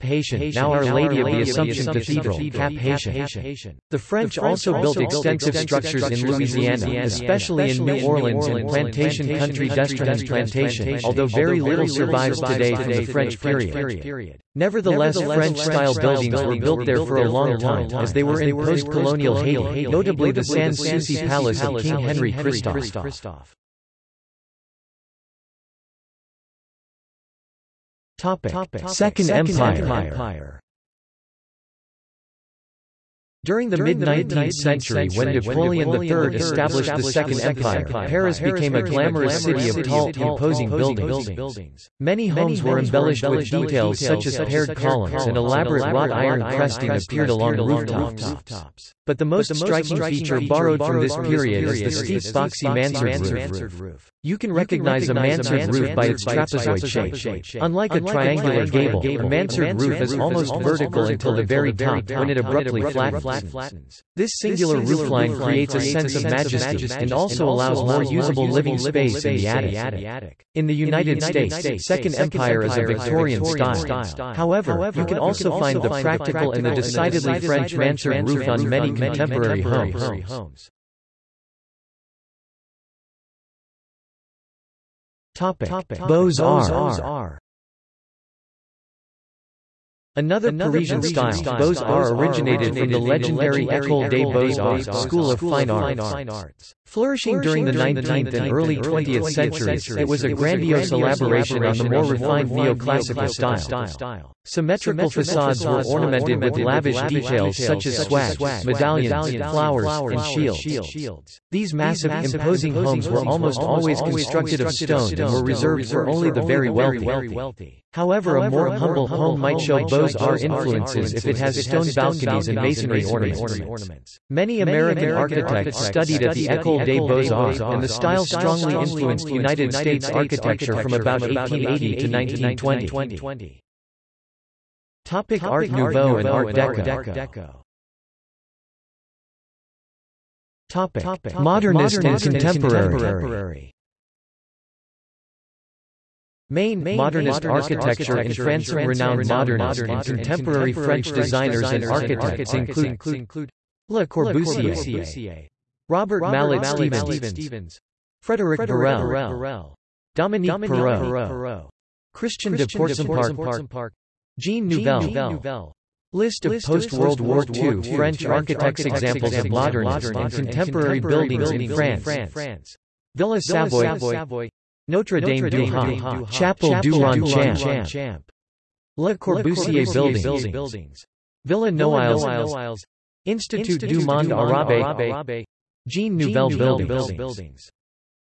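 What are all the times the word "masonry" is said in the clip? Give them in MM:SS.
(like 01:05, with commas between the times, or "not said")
02:02.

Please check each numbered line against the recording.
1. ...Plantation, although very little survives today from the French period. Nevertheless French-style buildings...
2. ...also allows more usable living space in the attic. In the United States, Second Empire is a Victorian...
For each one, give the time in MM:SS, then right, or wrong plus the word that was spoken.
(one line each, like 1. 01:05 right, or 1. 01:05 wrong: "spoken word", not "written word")
1. 00:10 right
2. 01:07 right.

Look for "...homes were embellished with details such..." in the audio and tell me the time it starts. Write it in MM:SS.
00:42.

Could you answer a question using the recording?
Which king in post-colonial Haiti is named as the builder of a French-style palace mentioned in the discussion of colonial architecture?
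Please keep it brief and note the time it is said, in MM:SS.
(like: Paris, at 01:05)
Henry Christophe, at 00:21.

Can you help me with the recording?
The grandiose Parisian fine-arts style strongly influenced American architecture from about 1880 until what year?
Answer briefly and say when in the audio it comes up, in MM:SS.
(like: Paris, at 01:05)
1920, at 02:12.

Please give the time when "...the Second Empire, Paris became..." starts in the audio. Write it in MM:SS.
00:36.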